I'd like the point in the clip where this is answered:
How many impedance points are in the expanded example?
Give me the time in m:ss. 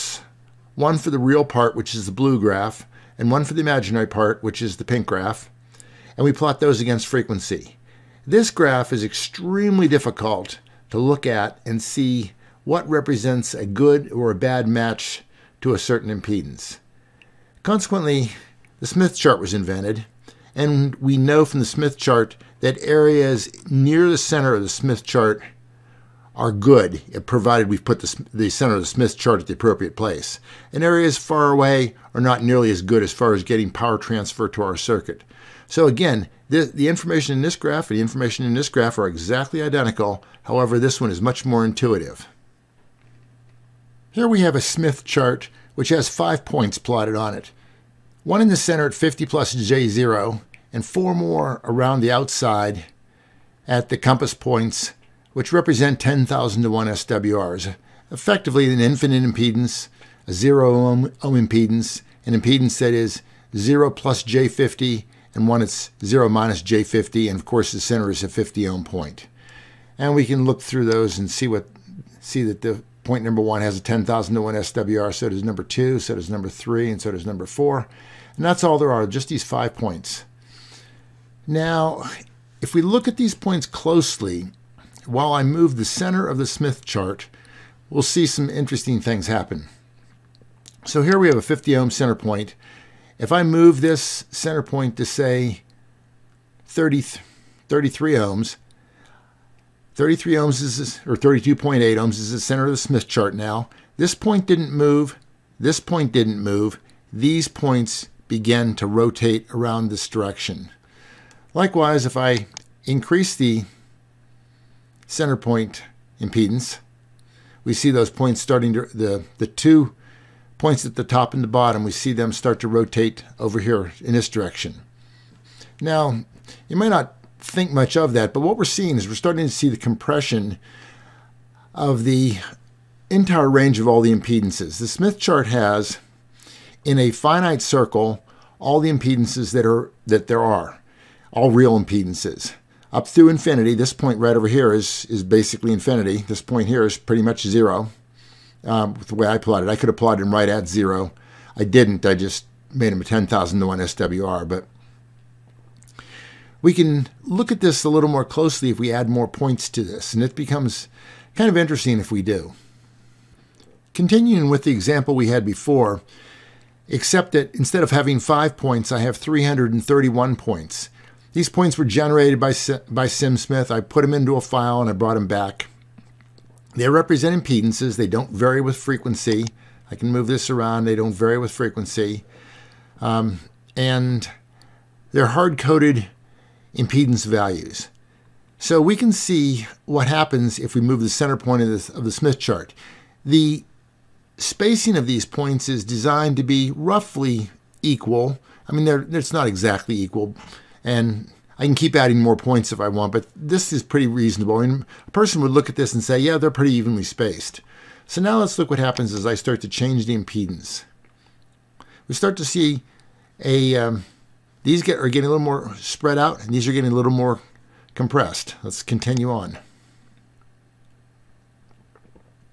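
2:49.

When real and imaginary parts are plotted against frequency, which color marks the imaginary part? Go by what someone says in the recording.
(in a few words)
Pink.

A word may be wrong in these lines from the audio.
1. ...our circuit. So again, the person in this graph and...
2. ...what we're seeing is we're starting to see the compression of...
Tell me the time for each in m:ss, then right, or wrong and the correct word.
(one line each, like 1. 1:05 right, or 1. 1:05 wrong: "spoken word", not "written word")
1. 0:34 wrong: "information", not "person"
2. 2:08 right.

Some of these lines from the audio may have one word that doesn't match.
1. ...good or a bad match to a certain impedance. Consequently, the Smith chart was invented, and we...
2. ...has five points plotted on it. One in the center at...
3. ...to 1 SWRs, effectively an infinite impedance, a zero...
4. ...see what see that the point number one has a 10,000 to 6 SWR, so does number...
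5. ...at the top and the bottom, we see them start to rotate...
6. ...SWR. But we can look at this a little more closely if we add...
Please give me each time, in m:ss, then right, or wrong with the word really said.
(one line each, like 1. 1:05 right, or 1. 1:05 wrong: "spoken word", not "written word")
1. 0:13 right
2. 0:45 right
3. 0:56 right
4. 1:11 wrong: "1", not "6"
5. 2:00 right
6. 2:33 right.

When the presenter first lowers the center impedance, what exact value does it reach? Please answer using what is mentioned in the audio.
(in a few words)
32.8 ohms.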